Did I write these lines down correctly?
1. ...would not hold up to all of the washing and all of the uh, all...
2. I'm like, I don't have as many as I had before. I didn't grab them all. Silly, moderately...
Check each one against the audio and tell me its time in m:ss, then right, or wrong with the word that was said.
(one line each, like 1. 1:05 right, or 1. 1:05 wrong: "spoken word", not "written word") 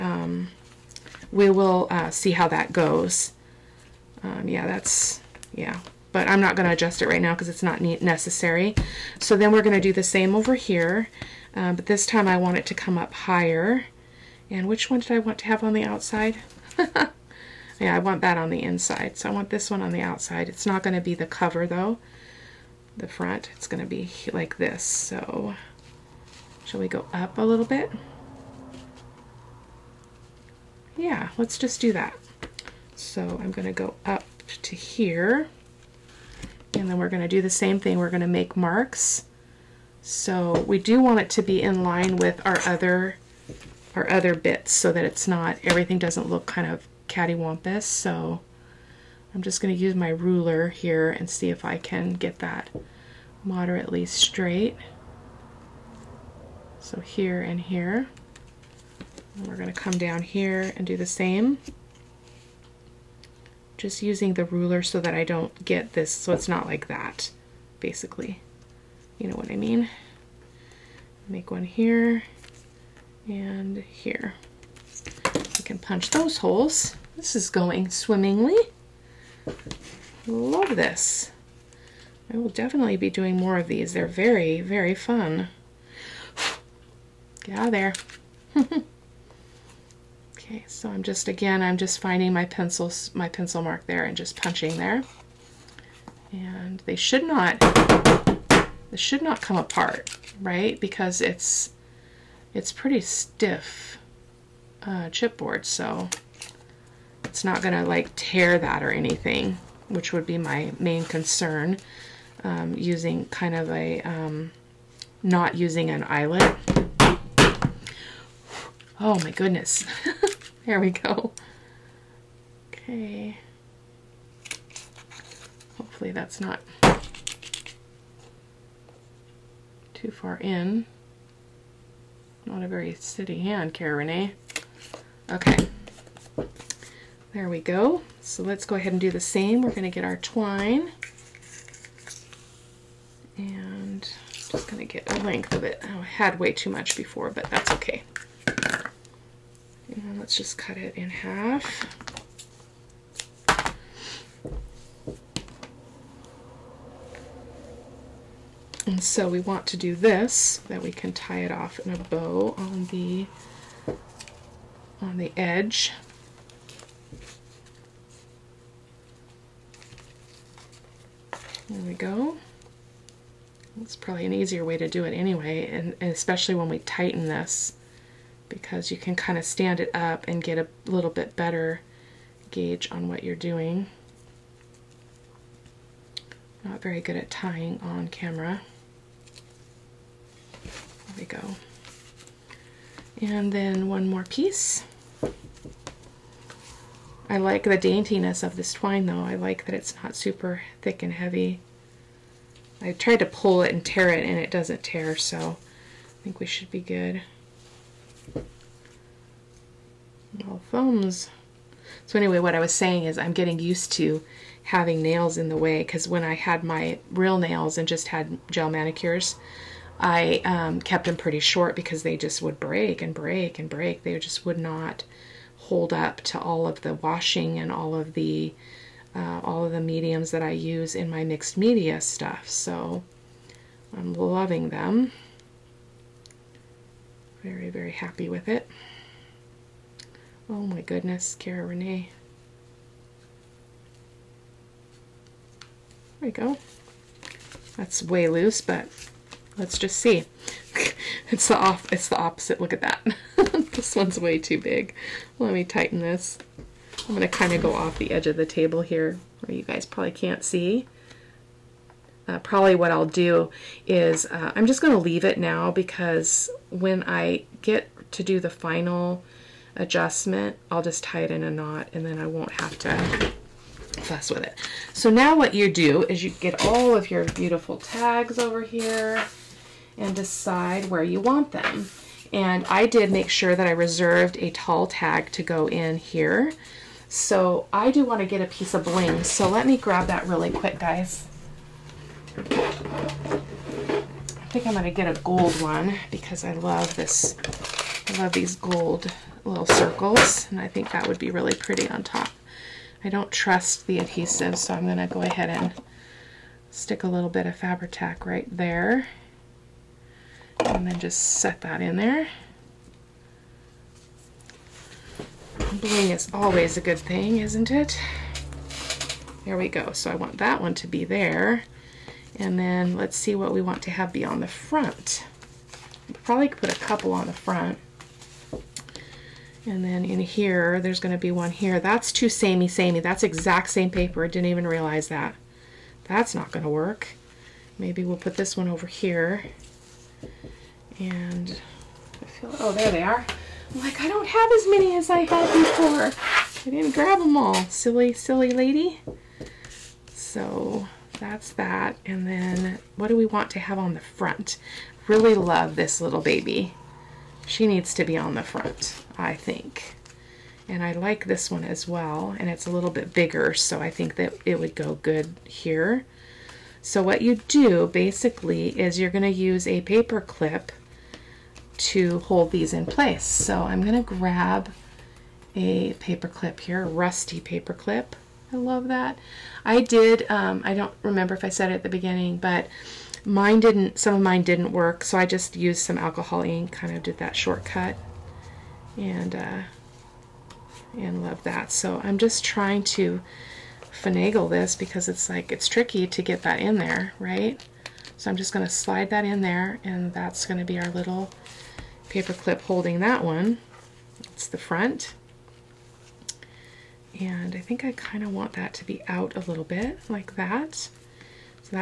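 1. 3:44 right
2. 5:43 wrong: "silly", not "moderately".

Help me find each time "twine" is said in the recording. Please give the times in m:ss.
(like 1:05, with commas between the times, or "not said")
2:20, 3:18.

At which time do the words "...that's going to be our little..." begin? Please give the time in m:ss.
6:40.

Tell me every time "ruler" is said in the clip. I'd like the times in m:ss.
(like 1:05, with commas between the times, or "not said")
0:50, 1:04.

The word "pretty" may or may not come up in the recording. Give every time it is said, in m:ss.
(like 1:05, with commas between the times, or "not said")
1:42, 3:41, 5:01.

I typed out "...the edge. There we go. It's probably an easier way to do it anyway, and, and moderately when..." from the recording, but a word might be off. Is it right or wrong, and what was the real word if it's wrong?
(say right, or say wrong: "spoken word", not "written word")
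wrong: "especially", not "moderately".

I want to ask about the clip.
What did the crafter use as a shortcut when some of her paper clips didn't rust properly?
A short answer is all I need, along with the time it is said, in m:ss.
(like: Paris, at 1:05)
alcohol ink, at 6:25.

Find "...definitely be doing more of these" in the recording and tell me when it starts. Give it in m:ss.
1:22.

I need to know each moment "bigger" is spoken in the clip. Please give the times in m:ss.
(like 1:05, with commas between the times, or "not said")
6:03.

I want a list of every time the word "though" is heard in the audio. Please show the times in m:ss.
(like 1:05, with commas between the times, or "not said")
0:21, 3:19.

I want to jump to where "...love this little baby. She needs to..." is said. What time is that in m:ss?
5:55.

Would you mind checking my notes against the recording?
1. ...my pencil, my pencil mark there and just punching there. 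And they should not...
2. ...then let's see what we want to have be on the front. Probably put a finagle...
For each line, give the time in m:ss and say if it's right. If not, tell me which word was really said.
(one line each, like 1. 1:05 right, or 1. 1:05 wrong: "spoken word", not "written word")
1. 1:32 right
2. 5:22 wrong: "couple", not "finagle".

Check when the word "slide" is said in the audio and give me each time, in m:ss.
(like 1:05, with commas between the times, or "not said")
6:38.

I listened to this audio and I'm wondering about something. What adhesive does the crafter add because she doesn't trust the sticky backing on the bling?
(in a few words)
Fabri-Tac.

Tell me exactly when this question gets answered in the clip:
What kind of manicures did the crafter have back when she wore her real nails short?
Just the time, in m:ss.
3:38.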